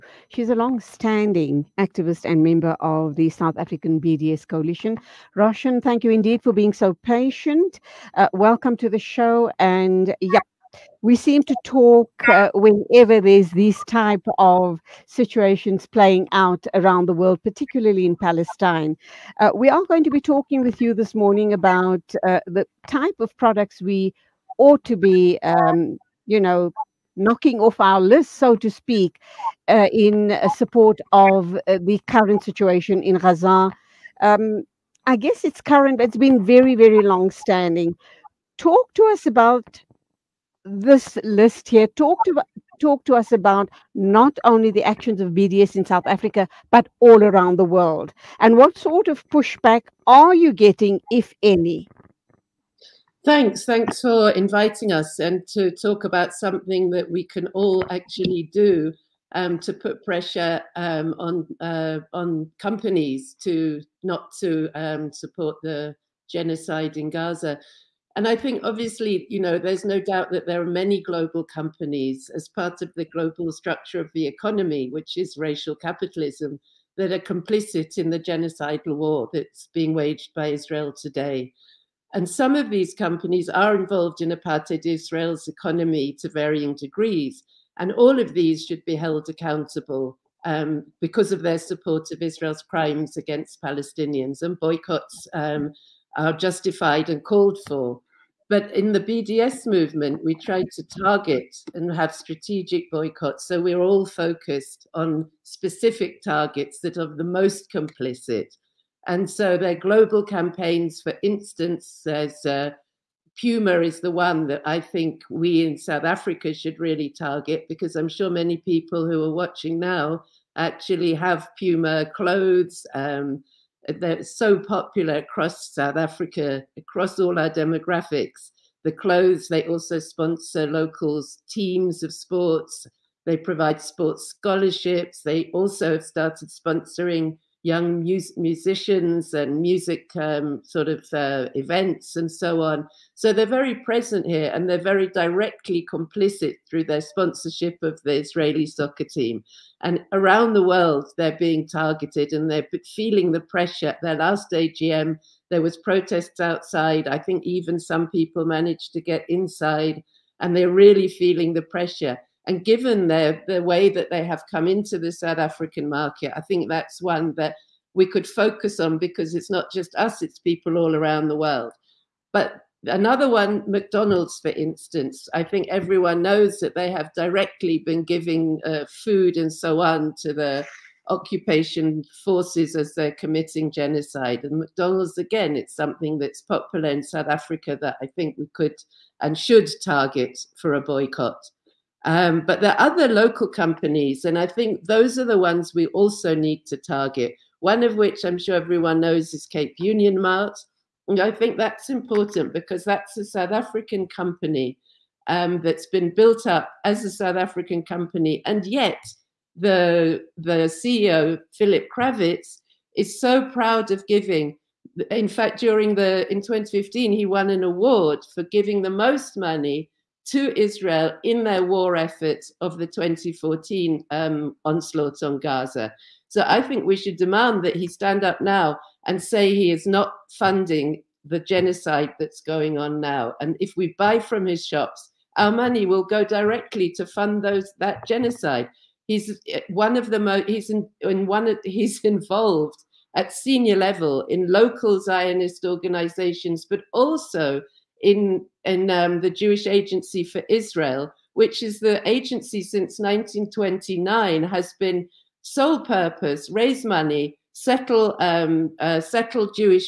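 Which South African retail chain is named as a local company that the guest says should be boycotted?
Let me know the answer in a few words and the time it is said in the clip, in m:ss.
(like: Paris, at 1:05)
Cape Union Mart, at 3:19.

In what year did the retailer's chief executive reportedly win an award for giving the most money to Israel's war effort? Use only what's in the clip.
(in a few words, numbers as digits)
2015.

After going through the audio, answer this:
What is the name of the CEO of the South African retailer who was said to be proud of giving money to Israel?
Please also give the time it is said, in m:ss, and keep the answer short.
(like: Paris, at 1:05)
Philip Krawitz, at 3:31.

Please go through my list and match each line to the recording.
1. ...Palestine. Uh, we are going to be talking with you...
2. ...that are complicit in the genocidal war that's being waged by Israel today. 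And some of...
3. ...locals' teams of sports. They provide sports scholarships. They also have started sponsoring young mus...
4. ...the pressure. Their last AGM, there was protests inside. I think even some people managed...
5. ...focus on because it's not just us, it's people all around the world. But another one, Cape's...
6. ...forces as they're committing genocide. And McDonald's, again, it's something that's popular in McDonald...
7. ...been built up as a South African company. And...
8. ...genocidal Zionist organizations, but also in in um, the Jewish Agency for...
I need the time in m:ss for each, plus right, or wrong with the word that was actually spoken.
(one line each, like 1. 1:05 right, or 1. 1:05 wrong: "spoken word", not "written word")
1. 0:18 right
2. 1:16 right
3. 2:10 right
4. 2:33 wrong: "outside", not "inside"
5. 2:48 wrong: "McDonald", not "Cape"
6. 3:02 wrong: "South", not "McDonald"
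7. 3:25 right
8. 4:04 wrong: "local", not "genocidal".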